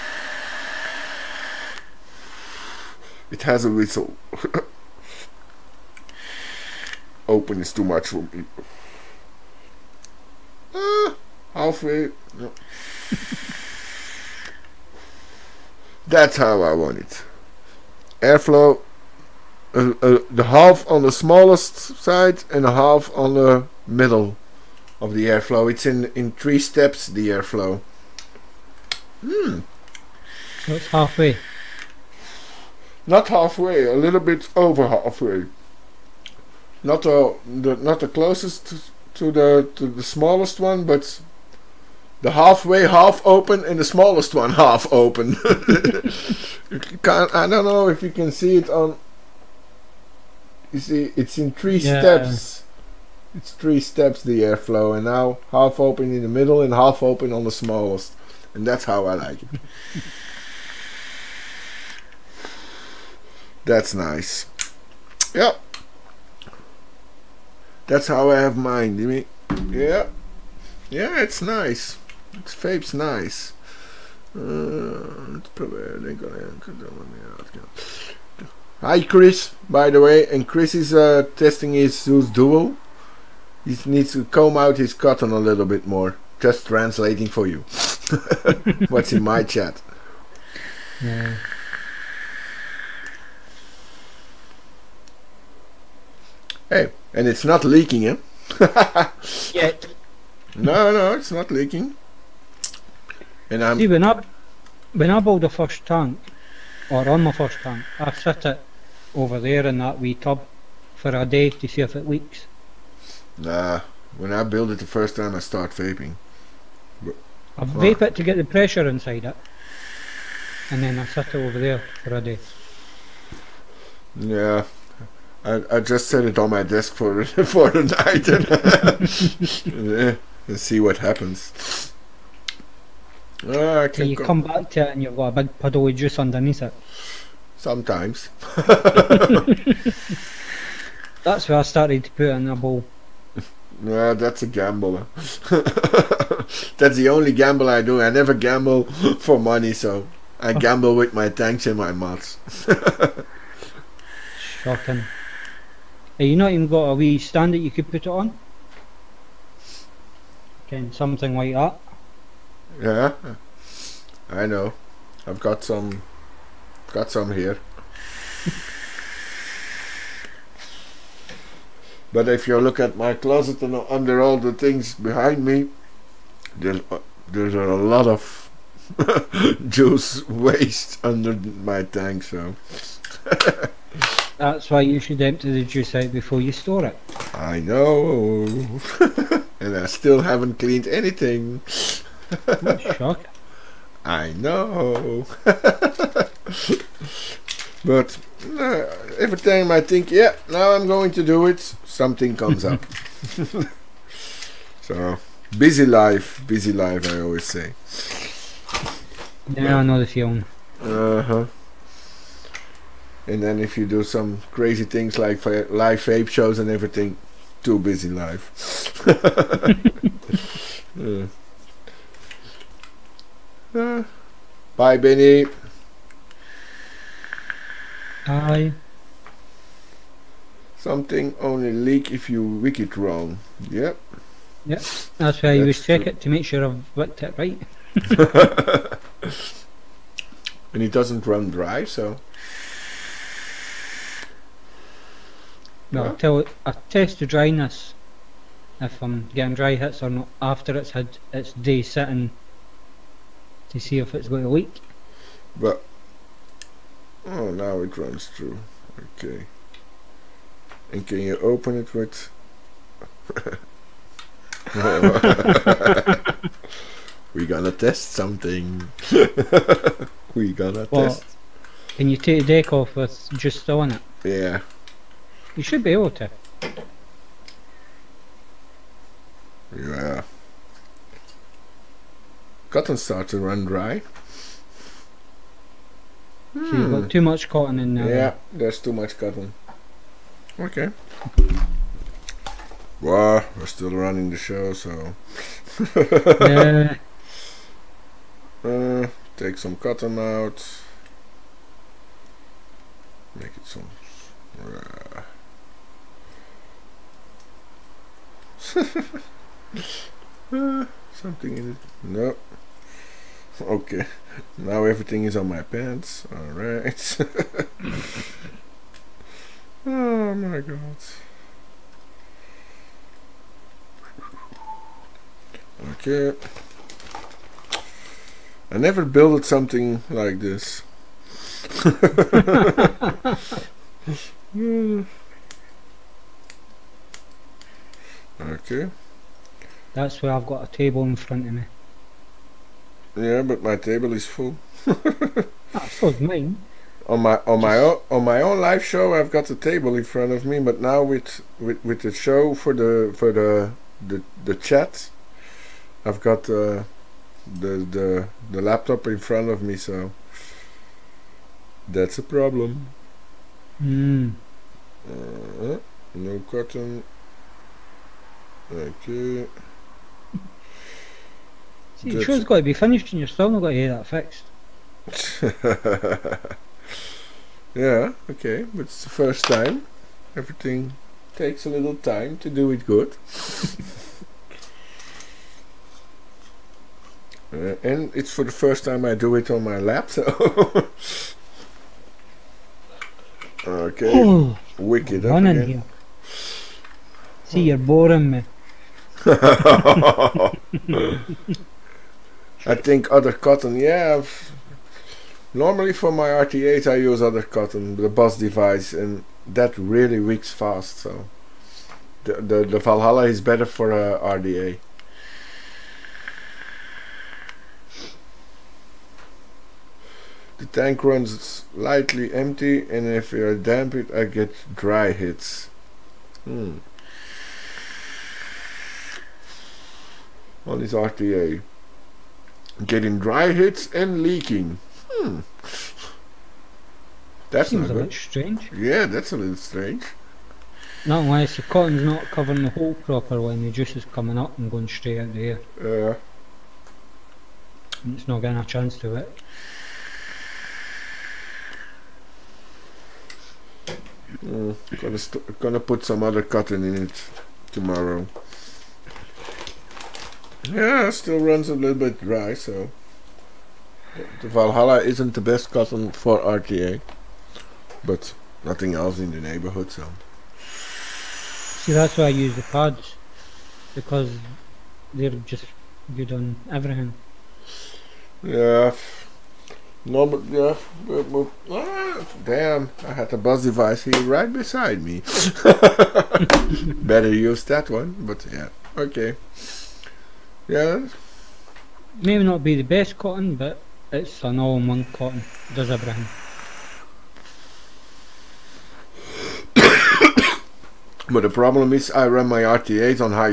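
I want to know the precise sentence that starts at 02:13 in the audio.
Uh, so you come back to it and you've got a big puddle of juice underneath it.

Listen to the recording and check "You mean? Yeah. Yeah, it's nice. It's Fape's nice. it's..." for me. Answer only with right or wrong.
right.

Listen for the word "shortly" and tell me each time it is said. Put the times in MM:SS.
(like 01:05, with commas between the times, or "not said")
not said.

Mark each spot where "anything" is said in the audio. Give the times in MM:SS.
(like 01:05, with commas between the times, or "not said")
03:10.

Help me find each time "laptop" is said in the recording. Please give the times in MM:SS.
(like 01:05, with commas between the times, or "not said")
05:58, 06:29.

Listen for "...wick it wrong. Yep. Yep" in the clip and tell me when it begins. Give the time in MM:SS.
03:52.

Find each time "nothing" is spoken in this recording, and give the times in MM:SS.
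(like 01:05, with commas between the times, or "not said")
07:48.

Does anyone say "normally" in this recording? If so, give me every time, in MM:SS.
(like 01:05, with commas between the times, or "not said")
06:45.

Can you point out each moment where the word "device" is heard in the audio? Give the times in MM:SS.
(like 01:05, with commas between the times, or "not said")
06:48, 08:03.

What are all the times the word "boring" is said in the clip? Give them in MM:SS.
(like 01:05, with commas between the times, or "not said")
06:37.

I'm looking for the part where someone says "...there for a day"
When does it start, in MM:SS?
02:01.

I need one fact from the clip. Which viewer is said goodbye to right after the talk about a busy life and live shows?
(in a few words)
Benny.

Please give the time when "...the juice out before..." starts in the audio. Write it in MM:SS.
03:05.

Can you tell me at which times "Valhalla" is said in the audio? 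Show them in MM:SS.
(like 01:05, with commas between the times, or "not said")
06:52, 07:44.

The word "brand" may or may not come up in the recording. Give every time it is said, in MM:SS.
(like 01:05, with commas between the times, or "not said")
08:15.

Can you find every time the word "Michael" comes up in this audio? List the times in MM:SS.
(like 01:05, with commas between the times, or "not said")
not said.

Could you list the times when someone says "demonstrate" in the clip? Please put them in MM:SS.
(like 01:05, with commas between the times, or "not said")
not said.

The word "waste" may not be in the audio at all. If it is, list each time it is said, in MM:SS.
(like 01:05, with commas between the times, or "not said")
03:00.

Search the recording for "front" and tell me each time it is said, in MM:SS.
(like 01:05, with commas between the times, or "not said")
05:41, 05:50, 05:59.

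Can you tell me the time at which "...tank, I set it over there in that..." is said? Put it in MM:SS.
01:47.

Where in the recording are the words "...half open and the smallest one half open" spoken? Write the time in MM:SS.
00:42.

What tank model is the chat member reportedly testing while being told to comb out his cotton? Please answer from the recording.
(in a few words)
Zeus Duo.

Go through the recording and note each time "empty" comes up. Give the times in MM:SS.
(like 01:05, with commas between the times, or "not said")
03:05, 07:02.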